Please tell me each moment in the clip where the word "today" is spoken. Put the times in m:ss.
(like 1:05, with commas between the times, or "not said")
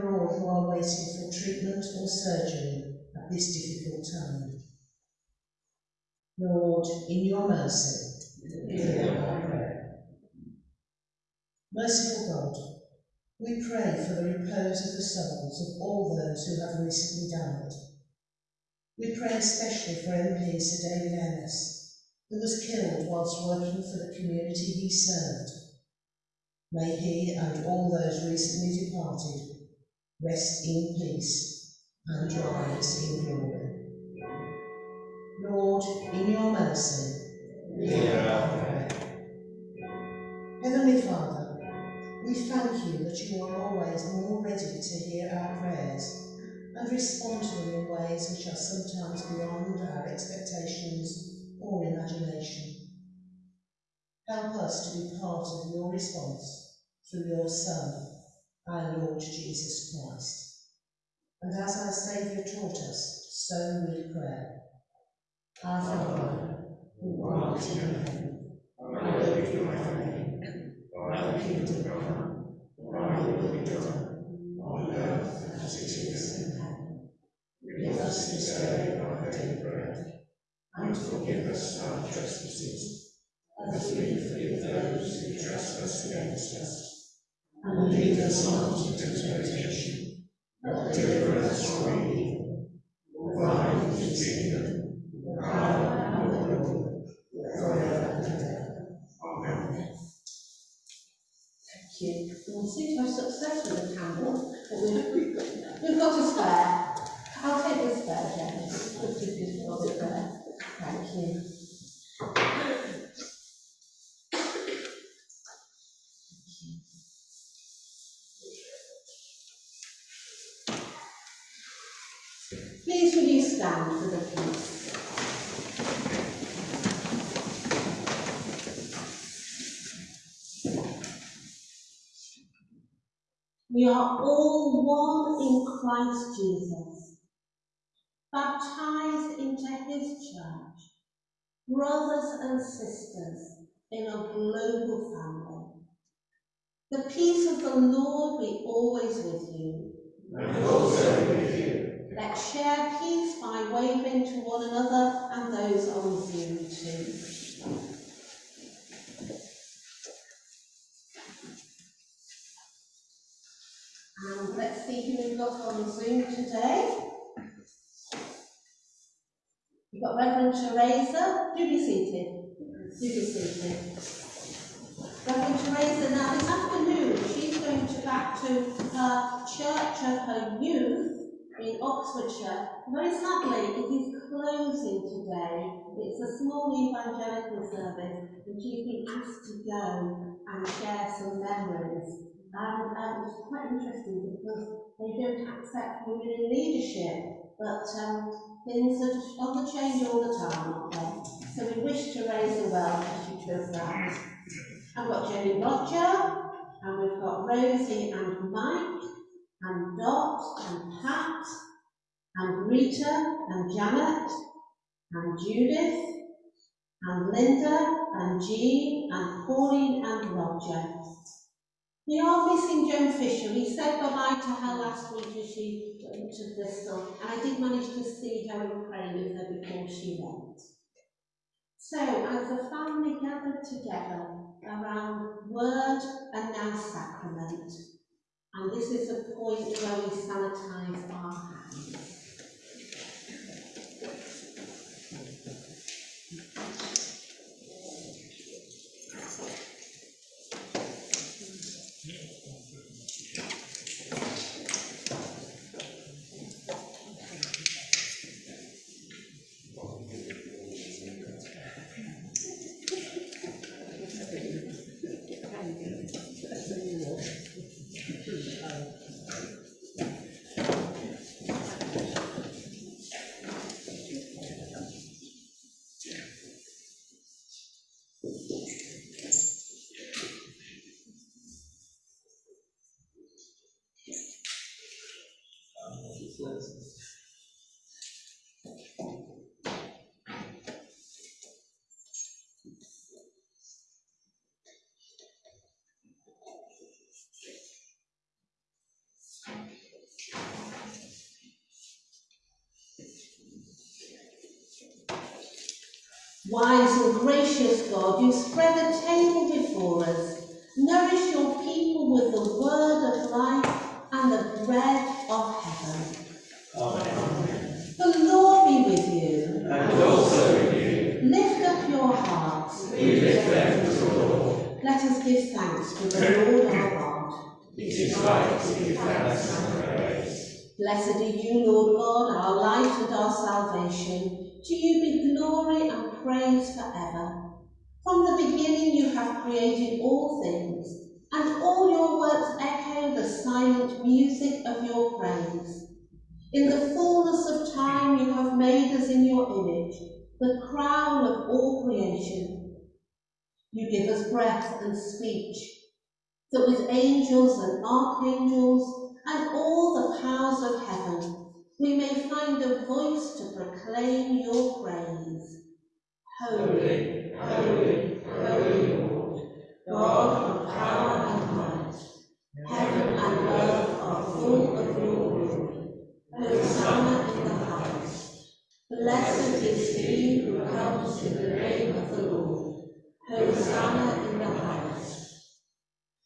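2:46, 3:05.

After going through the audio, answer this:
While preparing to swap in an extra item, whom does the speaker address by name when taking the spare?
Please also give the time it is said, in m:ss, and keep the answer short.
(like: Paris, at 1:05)
James, at 1:48.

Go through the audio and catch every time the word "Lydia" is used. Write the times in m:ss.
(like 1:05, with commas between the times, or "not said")
not said.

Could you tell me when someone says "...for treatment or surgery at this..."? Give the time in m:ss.
0:00.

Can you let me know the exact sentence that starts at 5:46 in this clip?
In the fullness of time you have made us in your image, the crown of all creation.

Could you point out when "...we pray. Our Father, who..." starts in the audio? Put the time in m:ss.
1:03.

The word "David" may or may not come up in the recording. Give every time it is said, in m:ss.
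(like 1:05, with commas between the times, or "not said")
0:20.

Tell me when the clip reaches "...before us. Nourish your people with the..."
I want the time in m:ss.
5:09.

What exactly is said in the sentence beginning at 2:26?
The peace of the Lord be always with you.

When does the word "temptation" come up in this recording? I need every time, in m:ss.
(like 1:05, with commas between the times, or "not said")
1:29.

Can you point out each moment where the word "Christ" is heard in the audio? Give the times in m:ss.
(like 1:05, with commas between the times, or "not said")
0:59, 2:15.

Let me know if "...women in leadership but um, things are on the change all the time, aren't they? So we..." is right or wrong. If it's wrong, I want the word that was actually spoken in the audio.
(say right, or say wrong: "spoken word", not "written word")
right.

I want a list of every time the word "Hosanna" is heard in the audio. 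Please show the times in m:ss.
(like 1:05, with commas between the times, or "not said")
6:16, 6:23.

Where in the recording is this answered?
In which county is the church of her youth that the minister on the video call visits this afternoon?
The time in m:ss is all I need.
3:01.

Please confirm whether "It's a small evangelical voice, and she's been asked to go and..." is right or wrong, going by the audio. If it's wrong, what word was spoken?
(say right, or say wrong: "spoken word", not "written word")
wrong: "service", not "voice".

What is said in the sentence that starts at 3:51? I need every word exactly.
So, as the family gathered together around word and now sacrament, and this is the point where we sanitize our hands.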